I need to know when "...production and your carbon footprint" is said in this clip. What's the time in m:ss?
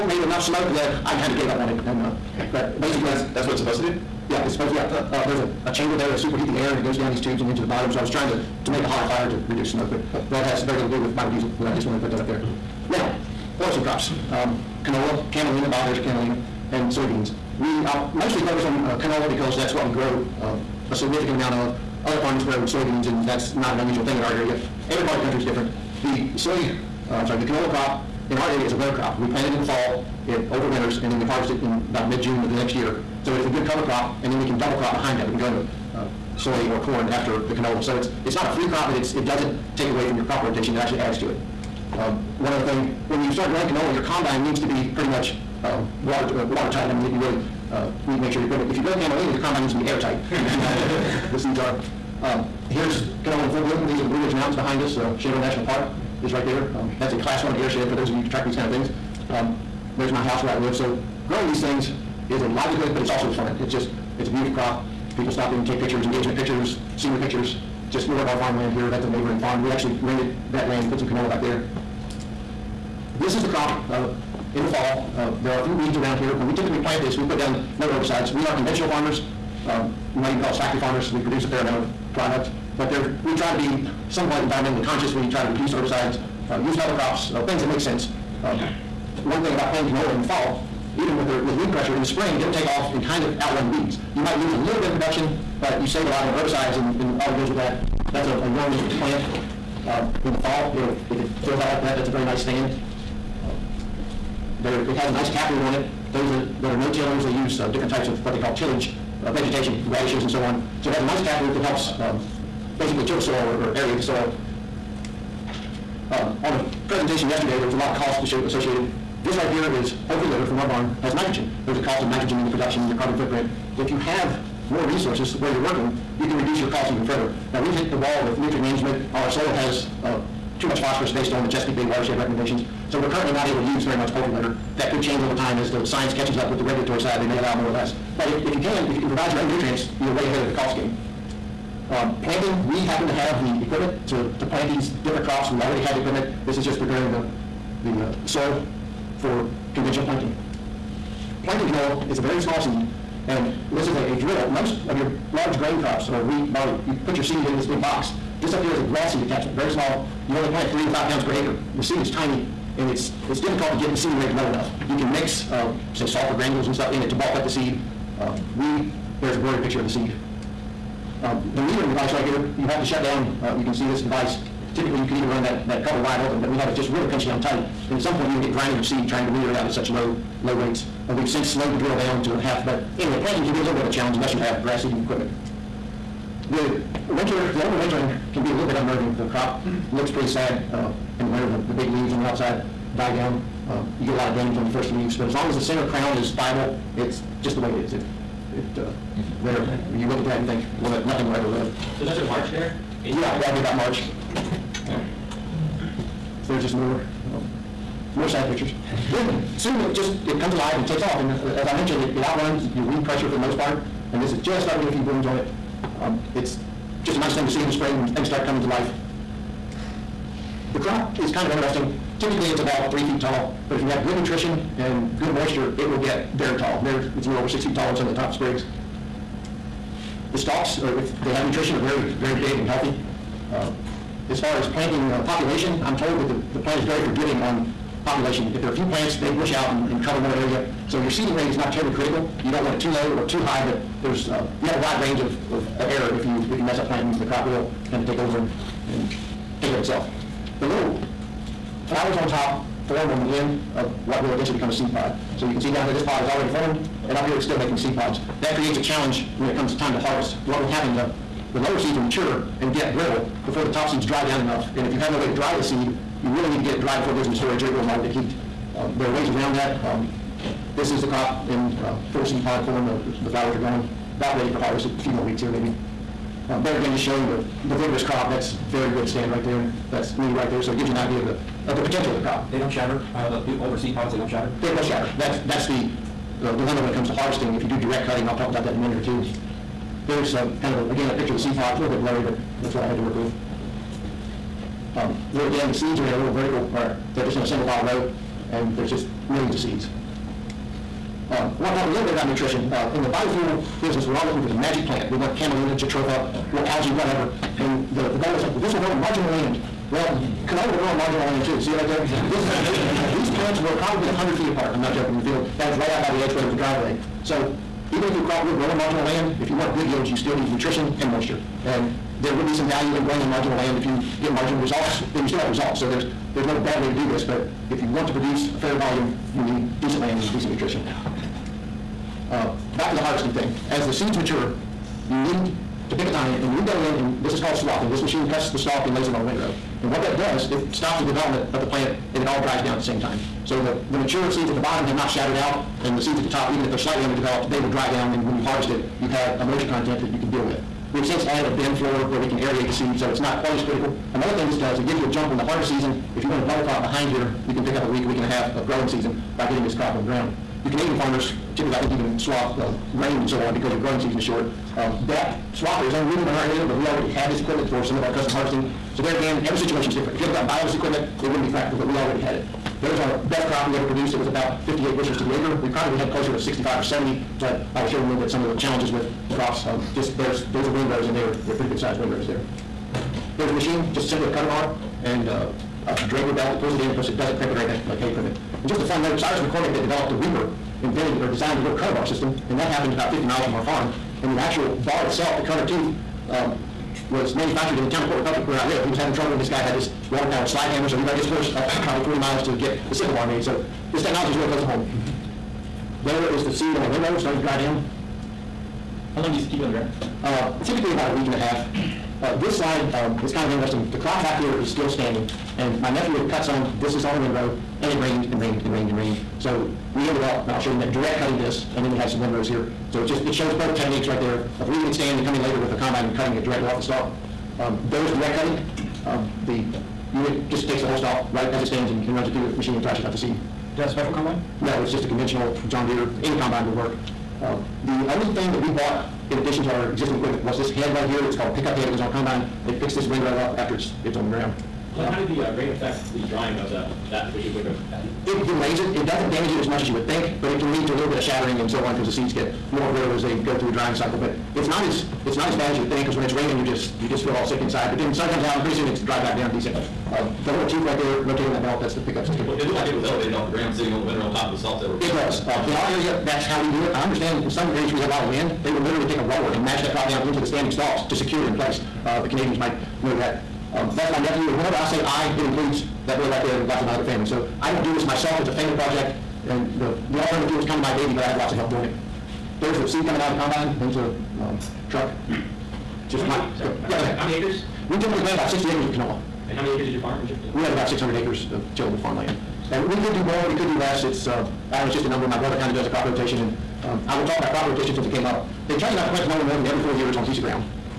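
2:02.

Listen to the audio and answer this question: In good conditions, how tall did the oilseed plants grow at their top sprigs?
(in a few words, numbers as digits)
over 6 feet.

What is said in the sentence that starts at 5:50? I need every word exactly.
We've since added a bin floor where we can aerate the seed so it's not quite as critical.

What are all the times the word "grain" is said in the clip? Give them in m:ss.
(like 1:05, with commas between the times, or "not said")
2:35, 6:02.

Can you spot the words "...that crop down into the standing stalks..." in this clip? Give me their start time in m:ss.
7:49.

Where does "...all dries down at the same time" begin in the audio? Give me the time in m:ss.
5:42.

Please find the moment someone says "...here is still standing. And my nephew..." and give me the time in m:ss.
6:54.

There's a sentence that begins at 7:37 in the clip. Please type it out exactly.
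But then sun comes out and pretty soon it's dried back down decent.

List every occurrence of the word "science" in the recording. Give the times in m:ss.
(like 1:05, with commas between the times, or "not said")
2:15.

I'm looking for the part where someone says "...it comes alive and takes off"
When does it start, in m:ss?
3:30.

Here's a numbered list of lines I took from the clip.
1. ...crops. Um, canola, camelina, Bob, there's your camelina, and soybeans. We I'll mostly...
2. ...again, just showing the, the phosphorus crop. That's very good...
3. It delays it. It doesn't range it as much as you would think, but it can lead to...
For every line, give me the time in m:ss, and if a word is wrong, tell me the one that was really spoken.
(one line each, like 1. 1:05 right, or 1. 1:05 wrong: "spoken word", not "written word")
1. 0:13 right
2. 4:36 wrong: "vigorous", not "phosphorus"
3. 7:28 wrong: "damage", not "range".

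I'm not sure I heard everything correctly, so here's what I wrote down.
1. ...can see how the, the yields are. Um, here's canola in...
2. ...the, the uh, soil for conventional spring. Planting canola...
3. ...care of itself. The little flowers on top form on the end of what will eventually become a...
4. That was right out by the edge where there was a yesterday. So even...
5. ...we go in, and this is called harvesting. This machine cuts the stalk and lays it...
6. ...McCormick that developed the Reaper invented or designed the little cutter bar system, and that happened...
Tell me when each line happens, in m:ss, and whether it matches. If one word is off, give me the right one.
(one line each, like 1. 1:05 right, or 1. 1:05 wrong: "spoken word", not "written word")
1. 0:50 wrong: "seeds", not "yields"
2. 2:27 wrong: "planting", not "spring"
3. 4:09 right
4. 5:15 wrong: "driveway", not "yesterday"
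5. 5:36 wrong: "swathing", not "harvesting"
6. 6:29 right.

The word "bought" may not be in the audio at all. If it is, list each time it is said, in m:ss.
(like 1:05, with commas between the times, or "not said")
7:18.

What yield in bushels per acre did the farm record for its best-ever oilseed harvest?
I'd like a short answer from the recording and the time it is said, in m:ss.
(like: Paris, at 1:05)
58, at 6:14.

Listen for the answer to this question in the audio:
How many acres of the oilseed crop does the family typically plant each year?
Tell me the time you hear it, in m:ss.
8:08.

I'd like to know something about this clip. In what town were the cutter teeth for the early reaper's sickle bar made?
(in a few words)
Port Republic.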